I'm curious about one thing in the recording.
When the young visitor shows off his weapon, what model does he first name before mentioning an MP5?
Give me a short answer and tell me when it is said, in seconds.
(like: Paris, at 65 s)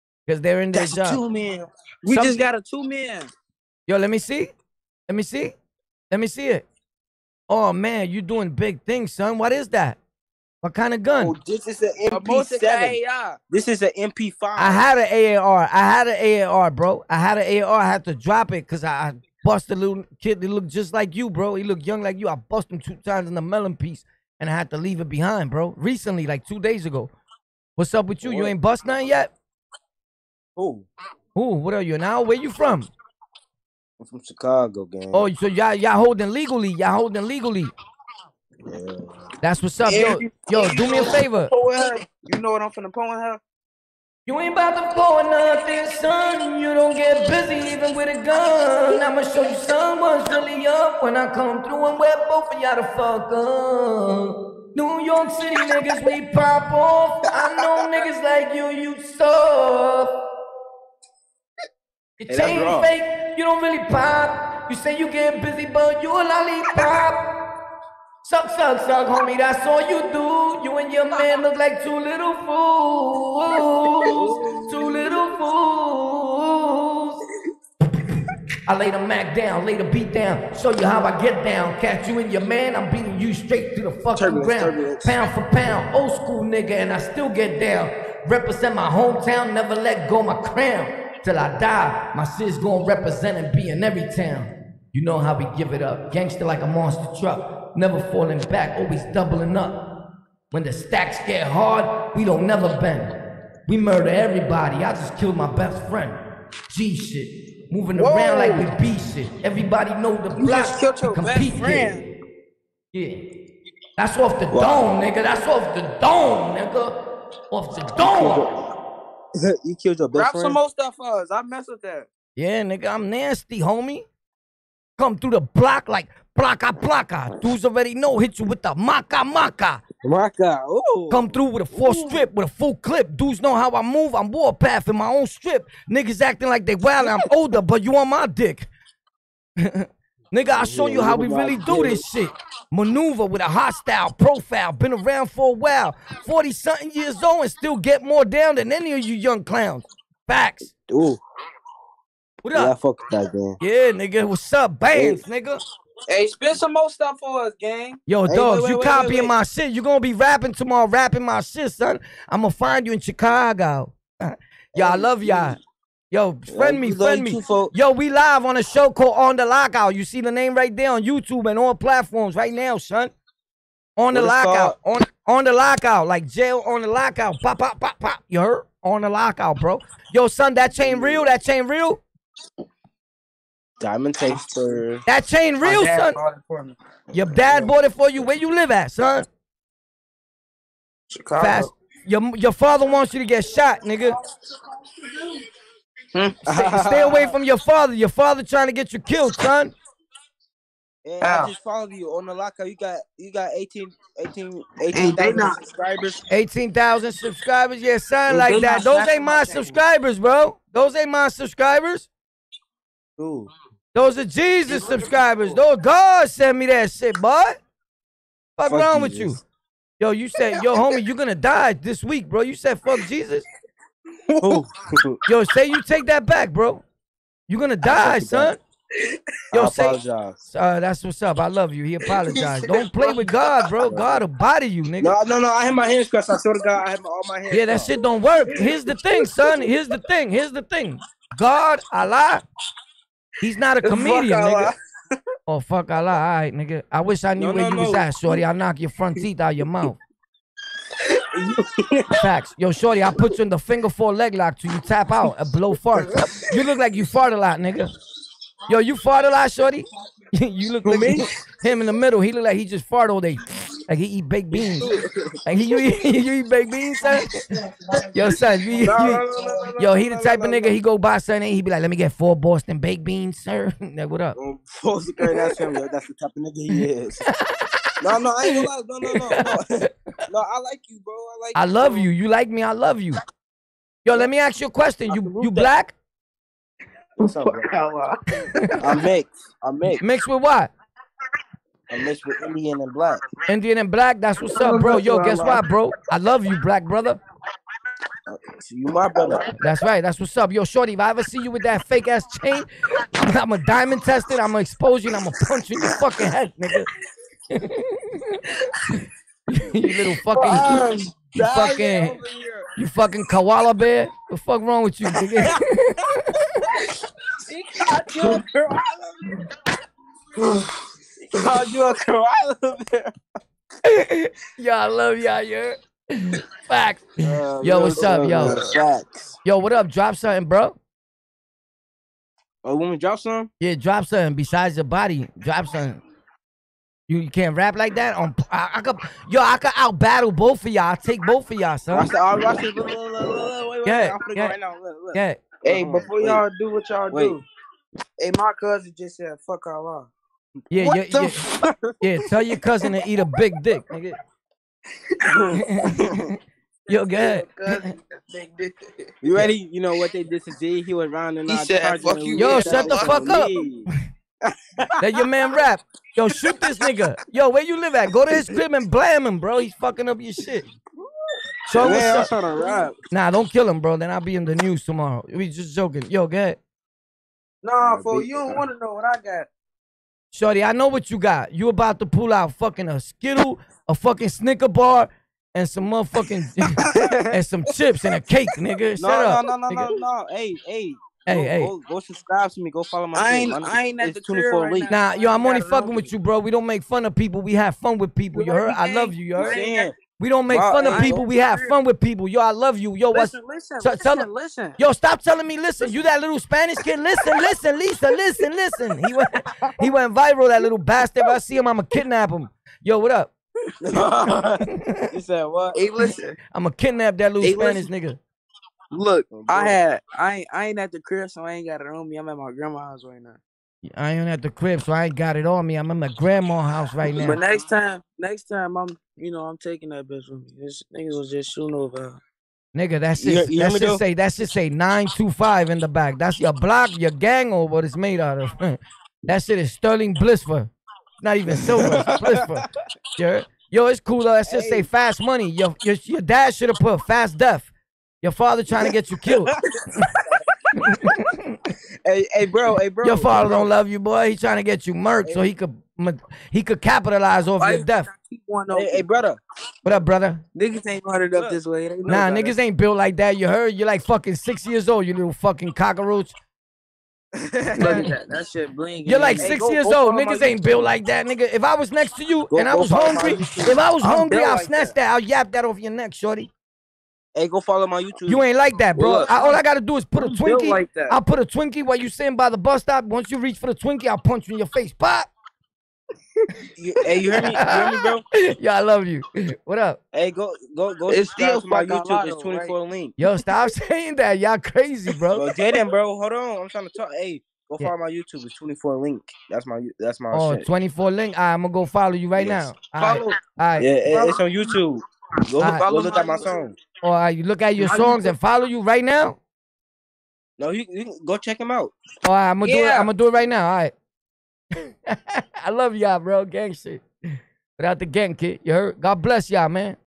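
MP7, at 12 s.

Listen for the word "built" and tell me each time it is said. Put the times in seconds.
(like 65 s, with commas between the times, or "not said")
462 s, 470 s.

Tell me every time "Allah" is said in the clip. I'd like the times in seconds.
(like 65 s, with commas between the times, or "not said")
241 s, 245 s, 349 s.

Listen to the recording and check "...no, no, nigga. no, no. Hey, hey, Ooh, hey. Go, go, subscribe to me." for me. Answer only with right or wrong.
wrong.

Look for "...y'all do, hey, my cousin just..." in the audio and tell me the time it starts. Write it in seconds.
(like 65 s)
346 s.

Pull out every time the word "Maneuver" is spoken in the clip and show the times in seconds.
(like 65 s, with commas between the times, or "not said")
142 s.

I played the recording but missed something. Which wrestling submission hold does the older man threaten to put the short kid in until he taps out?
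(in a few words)
Figure four leg lock.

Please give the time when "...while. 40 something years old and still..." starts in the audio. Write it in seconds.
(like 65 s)
145 s.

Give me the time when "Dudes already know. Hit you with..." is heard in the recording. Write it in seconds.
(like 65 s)
127 s.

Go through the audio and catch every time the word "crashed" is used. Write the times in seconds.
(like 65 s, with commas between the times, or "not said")
not said.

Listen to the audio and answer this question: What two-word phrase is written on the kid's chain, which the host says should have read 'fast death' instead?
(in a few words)
Fast money.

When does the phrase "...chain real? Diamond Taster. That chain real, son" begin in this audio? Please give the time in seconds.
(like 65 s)
181 s.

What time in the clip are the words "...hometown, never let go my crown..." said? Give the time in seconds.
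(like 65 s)
88 s.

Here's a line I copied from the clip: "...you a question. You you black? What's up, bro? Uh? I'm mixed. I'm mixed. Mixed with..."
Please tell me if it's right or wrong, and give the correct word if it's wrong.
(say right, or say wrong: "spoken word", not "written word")
right.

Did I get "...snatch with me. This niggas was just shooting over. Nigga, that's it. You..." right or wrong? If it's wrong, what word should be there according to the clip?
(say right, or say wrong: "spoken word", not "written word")
wrong: "bitch", not "snatch".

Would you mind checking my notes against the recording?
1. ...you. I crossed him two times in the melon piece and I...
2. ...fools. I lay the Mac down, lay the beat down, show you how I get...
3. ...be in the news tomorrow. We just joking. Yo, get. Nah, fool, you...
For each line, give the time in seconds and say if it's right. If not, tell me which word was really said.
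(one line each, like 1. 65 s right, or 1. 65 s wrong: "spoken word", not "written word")
1. 22 s wrong: "busted", not "crossed"
2. 75 s right
3. 374 s right.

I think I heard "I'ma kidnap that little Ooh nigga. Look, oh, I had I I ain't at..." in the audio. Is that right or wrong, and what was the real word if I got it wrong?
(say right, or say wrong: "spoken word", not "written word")
wrong: "Spanish", not "Ooh".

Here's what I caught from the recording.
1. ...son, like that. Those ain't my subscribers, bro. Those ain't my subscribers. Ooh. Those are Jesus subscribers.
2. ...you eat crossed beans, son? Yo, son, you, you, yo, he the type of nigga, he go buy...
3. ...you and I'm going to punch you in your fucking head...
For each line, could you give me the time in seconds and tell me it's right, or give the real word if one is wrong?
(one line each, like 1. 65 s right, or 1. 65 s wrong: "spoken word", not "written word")
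1. 207 s right
2. 266 s wrong: "baked", not "crossed"
3. 305 s right.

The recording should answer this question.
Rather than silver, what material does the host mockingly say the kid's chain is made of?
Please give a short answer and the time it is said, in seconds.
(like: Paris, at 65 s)
Sterling, at 439 s.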